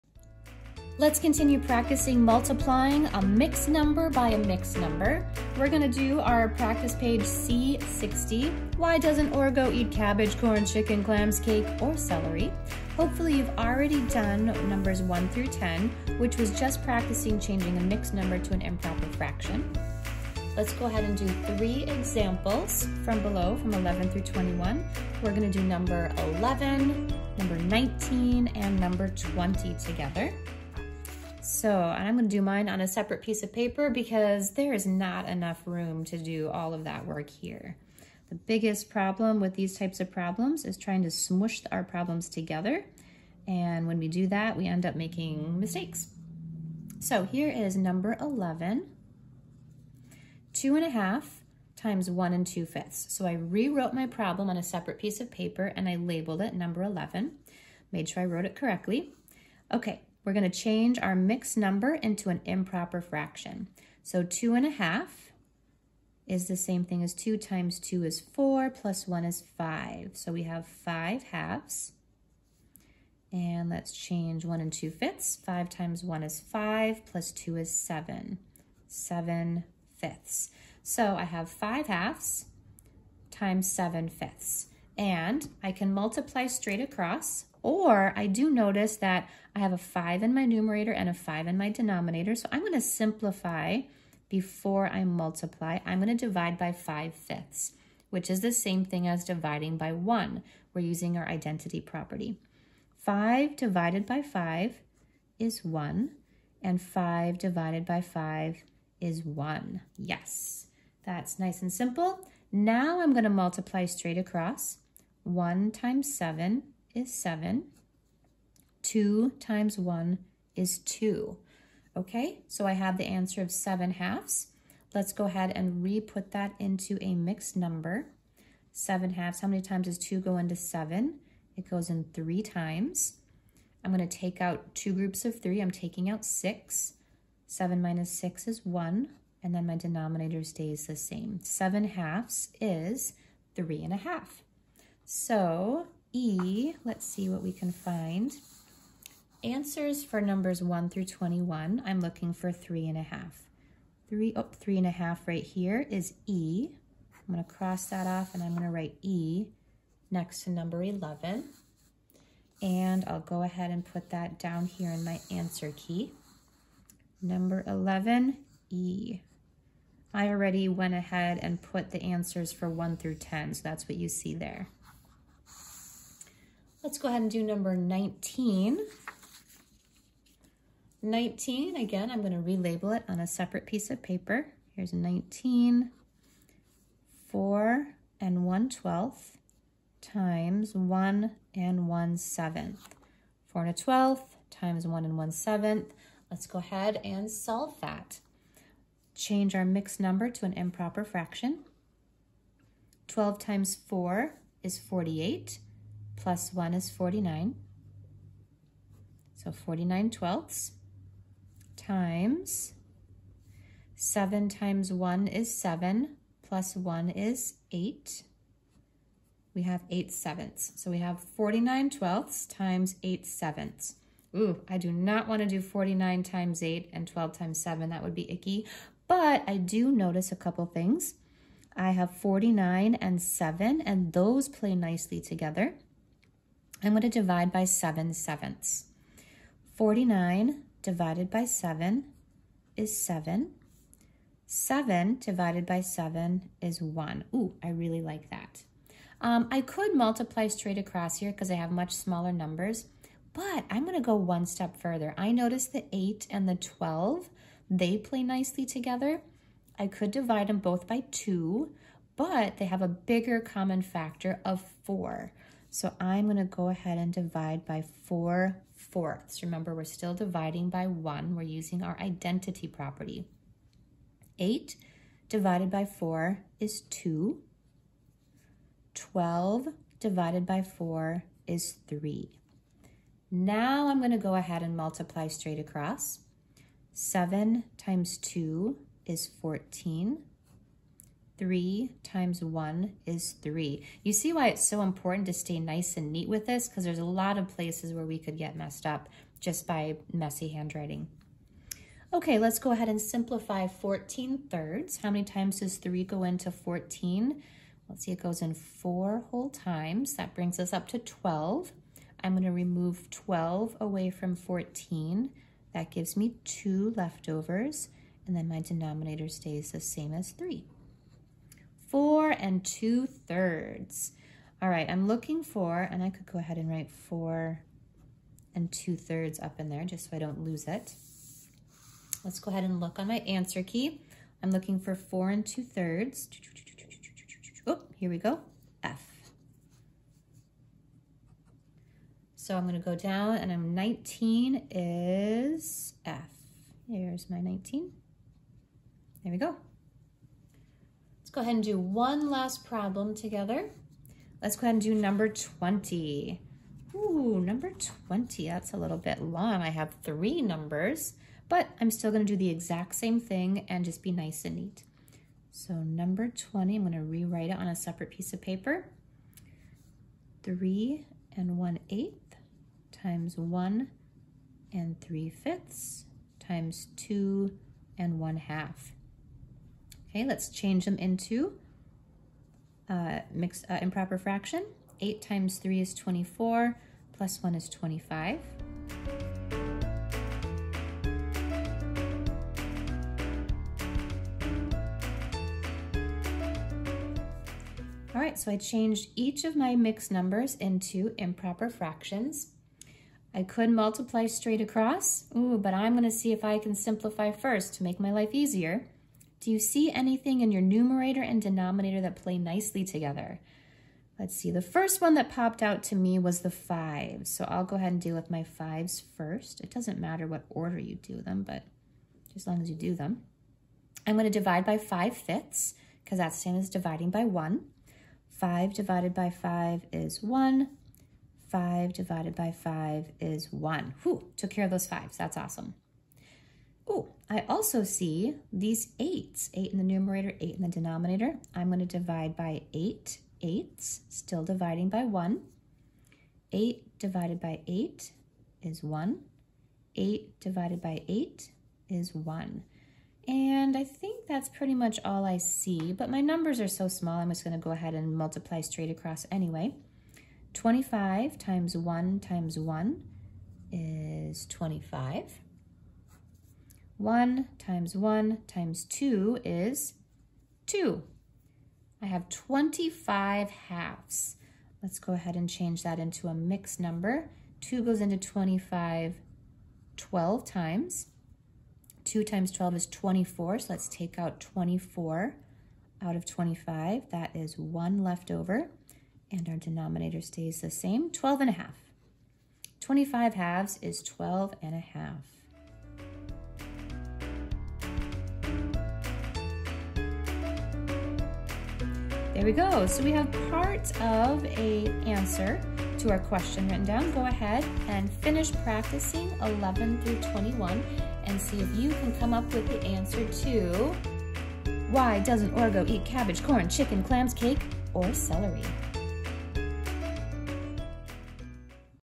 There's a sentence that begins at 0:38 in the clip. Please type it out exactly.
The biggest problem with these types of problems is trying to smoosh our problems together.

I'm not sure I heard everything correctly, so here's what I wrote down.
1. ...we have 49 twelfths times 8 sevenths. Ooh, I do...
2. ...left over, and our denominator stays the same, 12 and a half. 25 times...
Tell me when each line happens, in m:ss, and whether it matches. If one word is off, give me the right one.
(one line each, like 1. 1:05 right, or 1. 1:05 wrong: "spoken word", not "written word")
1. 3:40 right
2. 8:08 wrong: "halves", not "times".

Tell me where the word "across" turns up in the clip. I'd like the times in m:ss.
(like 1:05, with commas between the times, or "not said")
1:26, 1:54, 4:10, 4:45, 6:44, 7:38.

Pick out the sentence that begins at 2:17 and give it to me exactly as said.
7 minus 6 is 1, and then my denominator stays the same.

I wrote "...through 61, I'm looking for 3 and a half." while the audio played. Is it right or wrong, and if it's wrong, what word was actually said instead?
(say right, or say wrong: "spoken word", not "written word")
wrong: "21", not "61".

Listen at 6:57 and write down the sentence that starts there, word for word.
So I'll go ahead and deal with my fives first.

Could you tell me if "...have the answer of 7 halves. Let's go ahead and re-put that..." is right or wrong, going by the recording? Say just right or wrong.
right.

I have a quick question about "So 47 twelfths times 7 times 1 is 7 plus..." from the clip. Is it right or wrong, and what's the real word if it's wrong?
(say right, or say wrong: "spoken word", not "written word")
wrong: "49", not "47".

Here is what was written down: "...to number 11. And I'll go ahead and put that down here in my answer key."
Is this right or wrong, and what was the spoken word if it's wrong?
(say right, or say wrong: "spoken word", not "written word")
right.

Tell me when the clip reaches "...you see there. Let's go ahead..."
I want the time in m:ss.
2:53.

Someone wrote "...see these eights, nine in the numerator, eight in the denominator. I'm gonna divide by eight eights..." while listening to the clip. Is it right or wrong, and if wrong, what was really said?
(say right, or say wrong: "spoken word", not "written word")
wrong: "eight", not "nine".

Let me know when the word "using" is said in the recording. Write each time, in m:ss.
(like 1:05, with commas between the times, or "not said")
1:40, 4:31.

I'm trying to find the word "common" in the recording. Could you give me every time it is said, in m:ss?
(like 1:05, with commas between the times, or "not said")
4:23.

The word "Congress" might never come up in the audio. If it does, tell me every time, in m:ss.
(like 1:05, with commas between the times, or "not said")
not said.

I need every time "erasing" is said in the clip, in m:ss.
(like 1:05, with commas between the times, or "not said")
not said.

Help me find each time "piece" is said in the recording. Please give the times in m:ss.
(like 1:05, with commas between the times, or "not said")
0:33, 0:54, 3:03, 6:08.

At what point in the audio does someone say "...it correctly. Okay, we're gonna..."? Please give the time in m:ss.
0:58.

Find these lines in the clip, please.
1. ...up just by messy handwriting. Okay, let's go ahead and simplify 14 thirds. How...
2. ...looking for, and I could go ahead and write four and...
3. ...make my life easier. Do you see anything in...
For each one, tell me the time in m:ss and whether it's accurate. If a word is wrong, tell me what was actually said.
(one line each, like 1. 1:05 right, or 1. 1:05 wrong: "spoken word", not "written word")
1. 4:58 right
2. 5:25 right
3. 6:47 right.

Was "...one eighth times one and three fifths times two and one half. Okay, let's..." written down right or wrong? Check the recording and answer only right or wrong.
right.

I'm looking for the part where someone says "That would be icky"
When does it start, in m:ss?
3:47.